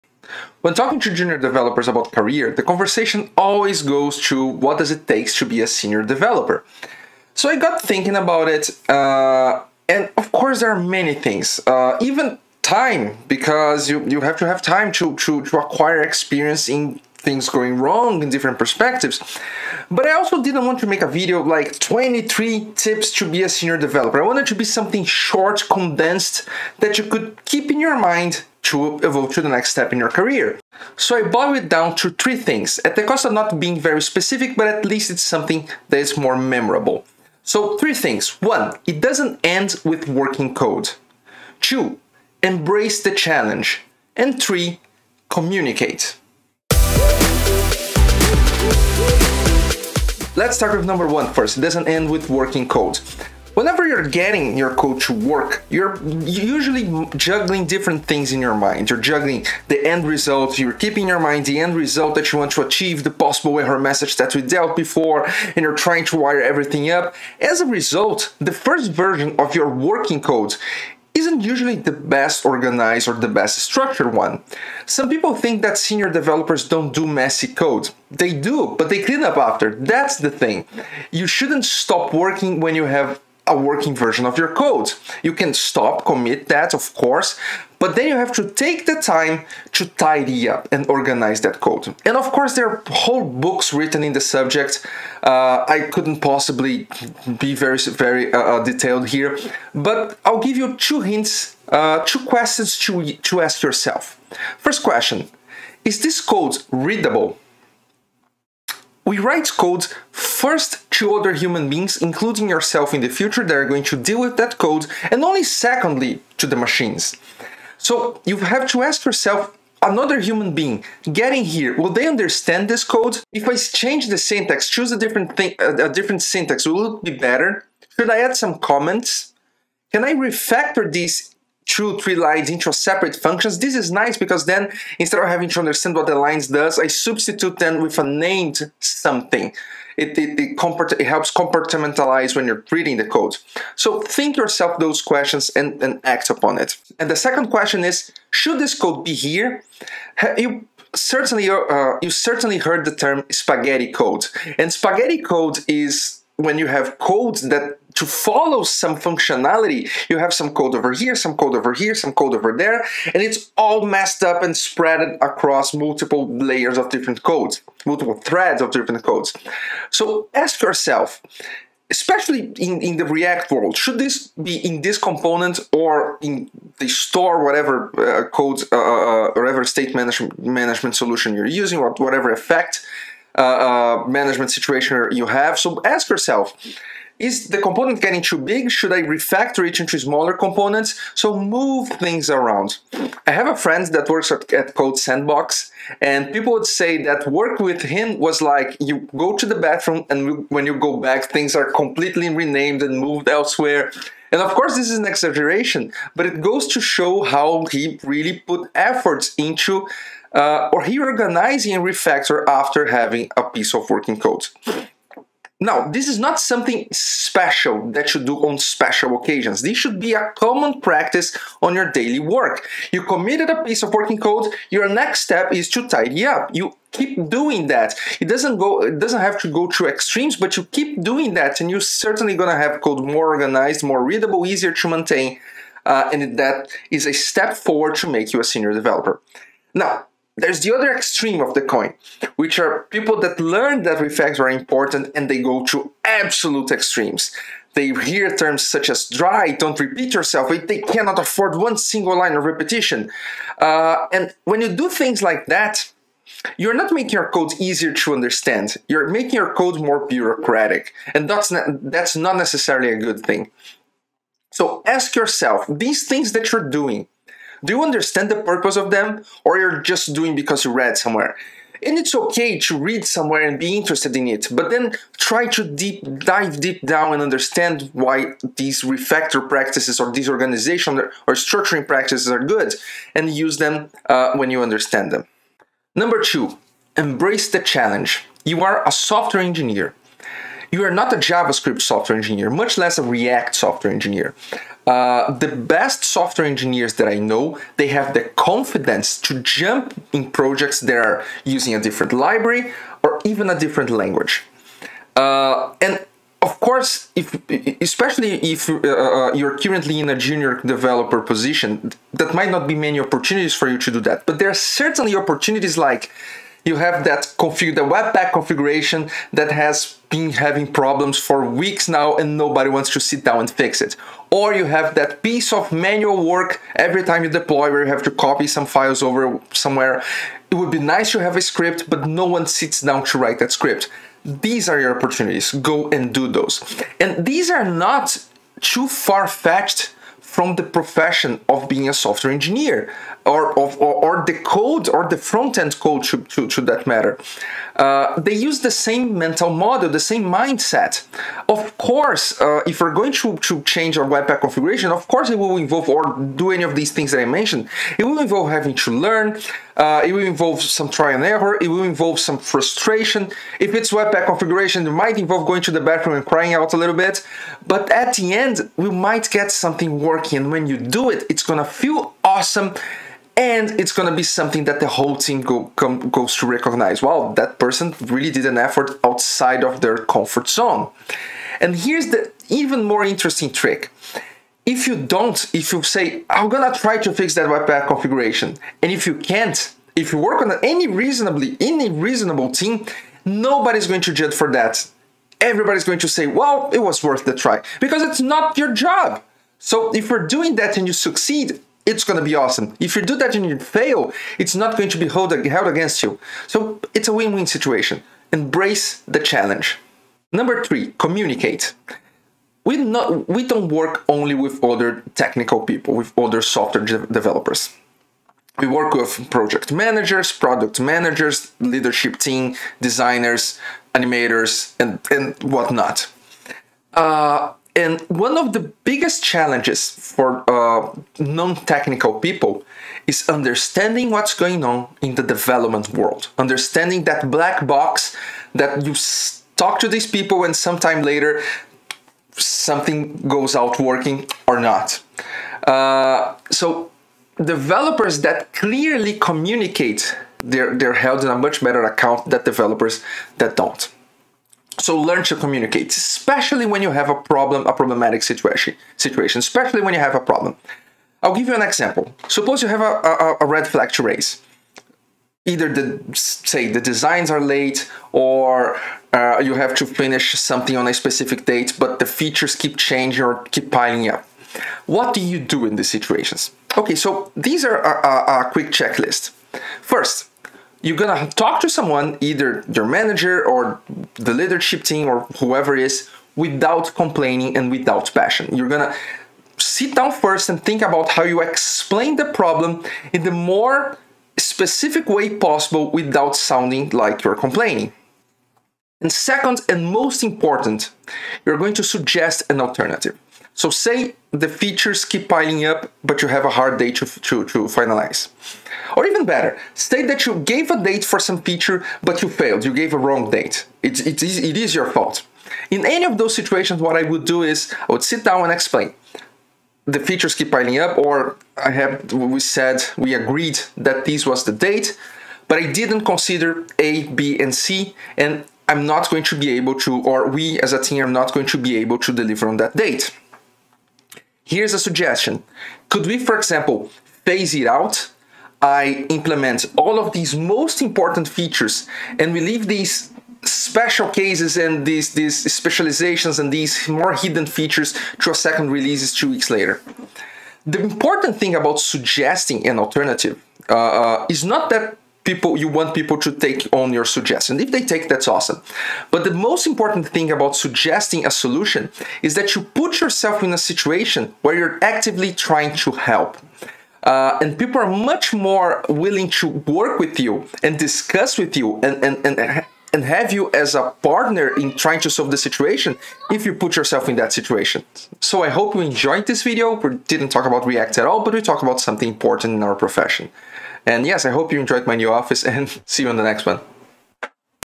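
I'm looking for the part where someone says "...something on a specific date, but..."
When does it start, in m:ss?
7:50.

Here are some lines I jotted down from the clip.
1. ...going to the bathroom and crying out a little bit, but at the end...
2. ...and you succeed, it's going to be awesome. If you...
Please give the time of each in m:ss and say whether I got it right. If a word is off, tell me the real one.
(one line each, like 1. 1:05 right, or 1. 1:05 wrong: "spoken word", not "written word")
1. 6:05 right
2. 6:40 right.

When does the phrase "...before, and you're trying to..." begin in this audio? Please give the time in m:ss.
1:04.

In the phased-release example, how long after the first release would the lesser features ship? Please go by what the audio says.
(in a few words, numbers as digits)
2 weeks.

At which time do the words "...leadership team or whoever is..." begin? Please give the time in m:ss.
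8:04.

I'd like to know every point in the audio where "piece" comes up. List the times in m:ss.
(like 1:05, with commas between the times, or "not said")
3:33, 3:43, 5:25.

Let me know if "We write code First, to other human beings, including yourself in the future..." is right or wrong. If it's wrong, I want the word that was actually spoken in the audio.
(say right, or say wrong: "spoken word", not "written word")
right.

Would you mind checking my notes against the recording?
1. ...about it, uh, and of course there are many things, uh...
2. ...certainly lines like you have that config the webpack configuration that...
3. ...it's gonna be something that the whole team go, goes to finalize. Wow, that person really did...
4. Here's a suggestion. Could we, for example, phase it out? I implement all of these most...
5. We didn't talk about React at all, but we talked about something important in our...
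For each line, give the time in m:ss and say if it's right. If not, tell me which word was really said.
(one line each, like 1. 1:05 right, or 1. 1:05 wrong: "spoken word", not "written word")
1. 0:08 right
2. 5:14 wrong: "opportunities", not "lines"
3. 6:13 wrong: "recognize", not "finalize"
4. 8:54 right
5. 9:39 right.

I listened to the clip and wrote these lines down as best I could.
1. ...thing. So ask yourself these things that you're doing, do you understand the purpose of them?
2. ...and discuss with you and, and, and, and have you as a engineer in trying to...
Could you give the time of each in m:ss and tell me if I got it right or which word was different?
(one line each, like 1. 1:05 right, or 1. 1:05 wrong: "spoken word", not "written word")
1. 4:23 right
2. 9:30 wrong: "partner", not "engineer".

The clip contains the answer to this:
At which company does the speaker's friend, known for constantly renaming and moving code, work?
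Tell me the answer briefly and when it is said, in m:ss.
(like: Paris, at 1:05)
Code Sandbox, at 3:14.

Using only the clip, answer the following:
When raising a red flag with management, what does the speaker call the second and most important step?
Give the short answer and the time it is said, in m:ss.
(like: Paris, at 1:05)
Suggest an alternative, at 8:21.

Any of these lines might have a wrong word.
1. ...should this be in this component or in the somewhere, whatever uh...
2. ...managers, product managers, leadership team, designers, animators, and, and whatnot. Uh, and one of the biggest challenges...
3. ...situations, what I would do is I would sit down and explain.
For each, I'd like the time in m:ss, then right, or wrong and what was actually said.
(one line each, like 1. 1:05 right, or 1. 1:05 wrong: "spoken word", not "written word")
1. 2:53 wrong: "store", not "somewhere"
2. 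6:59 right
3. 8:36 right.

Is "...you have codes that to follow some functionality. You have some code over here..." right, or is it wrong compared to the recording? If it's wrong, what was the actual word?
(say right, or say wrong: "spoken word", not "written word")
right.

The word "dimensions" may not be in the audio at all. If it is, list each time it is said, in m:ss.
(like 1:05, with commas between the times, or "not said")
not said.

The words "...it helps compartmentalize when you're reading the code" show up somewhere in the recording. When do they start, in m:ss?
2:20.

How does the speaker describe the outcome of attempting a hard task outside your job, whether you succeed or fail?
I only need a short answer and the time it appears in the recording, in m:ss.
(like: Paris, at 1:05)
A win-win situation, at 6:47.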